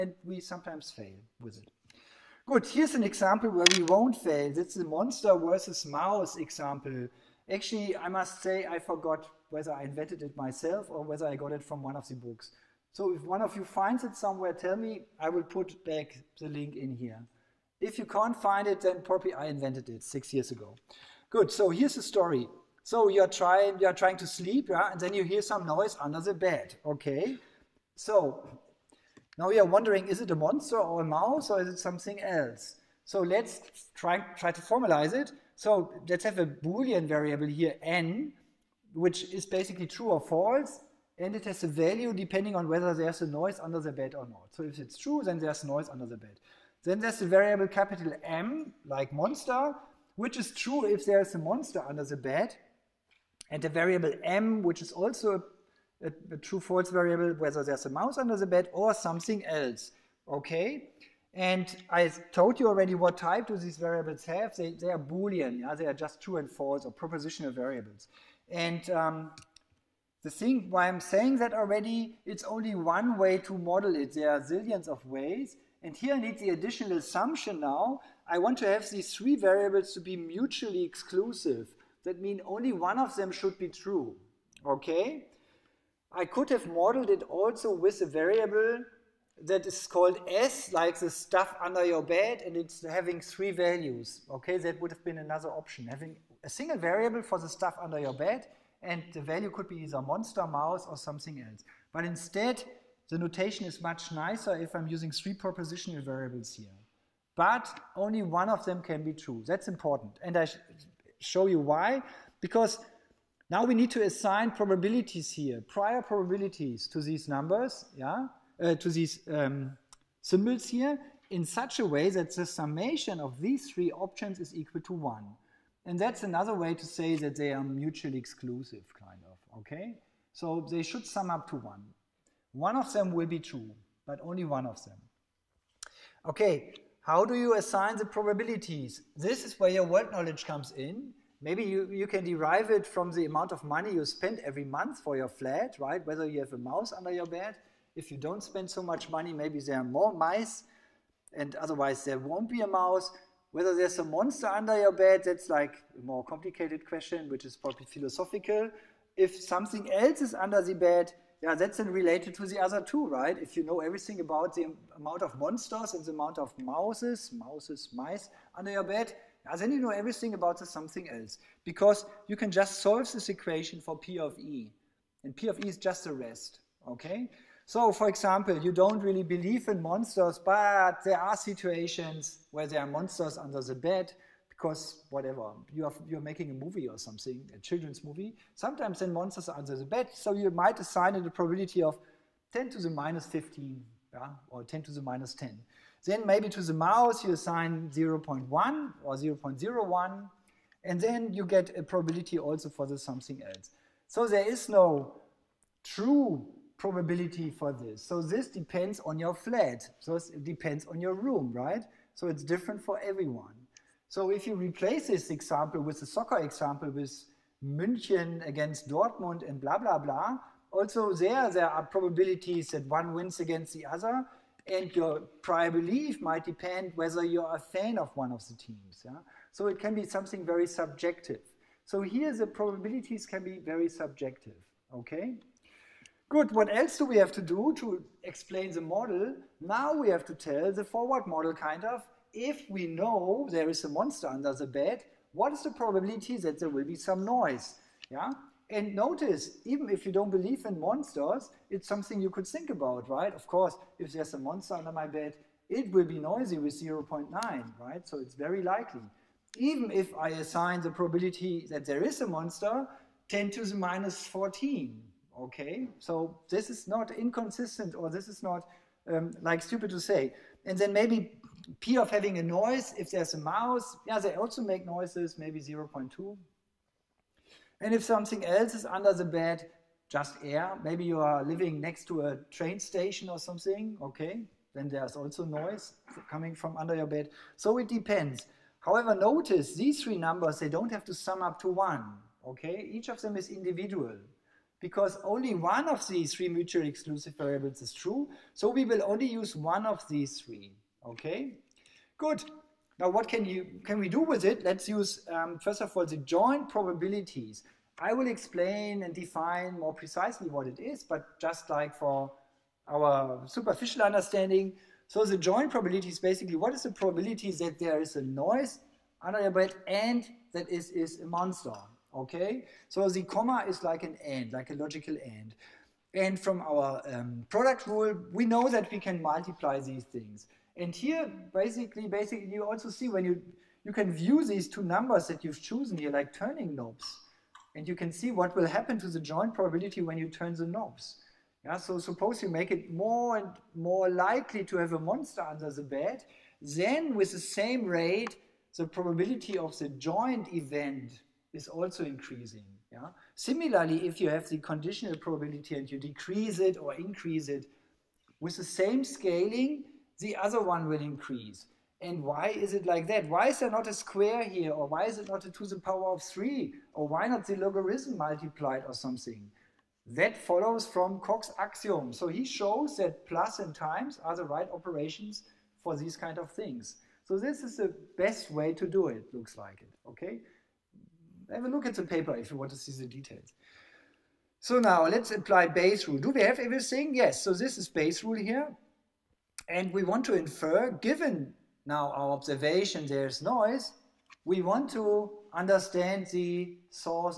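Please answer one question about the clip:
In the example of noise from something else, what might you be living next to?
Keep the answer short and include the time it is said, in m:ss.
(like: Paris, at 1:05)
a train station, at 4:42.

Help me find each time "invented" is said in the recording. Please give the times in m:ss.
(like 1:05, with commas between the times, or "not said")
0:09, 0:19.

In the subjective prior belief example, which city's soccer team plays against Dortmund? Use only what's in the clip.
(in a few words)
München.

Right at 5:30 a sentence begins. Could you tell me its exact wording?
And here, basically, basically, you also see when you, you can view these two numbers that you've chosen here, like turning knobs.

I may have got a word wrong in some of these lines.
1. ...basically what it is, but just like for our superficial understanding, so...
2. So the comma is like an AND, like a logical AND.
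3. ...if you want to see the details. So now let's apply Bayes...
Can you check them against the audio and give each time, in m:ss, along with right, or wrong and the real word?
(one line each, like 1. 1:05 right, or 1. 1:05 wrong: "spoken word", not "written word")
1. 5:09 wrong: "precisely", not "basically"
2. 5:22 right
3. 6:22 right.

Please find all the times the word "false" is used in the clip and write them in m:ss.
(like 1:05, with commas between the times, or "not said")
0:40, 0:56, 1:06.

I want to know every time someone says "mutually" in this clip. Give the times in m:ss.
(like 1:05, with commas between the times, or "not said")
1:20, 2:07, 4:56.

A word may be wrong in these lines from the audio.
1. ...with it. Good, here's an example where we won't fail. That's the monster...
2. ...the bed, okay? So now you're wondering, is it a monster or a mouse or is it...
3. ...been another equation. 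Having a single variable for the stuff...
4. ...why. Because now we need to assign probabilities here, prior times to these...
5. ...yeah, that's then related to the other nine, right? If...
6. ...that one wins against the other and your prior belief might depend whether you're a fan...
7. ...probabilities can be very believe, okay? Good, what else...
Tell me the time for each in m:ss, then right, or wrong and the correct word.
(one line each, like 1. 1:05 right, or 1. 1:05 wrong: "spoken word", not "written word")
1. 0:01 right
2. 0:26 right
3. 1:35 wrong: "option", not "equation"
4. 1:51 wrong: "probabilities", not "times"
5. 2:41 wrong: "two", not "nine"
6. 3:42 right
7. 3:52 wrong: "subjective", not "believe".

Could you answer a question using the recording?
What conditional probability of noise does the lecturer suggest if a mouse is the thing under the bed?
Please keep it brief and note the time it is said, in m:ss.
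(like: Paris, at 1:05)
0.2, at 4:35.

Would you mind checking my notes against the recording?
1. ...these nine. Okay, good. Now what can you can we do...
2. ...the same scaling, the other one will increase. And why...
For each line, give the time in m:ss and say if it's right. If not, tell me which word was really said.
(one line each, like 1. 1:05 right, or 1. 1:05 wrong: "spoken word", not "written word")
1. 5:00 wrong: "three", not "nine"
2. 5:58 right.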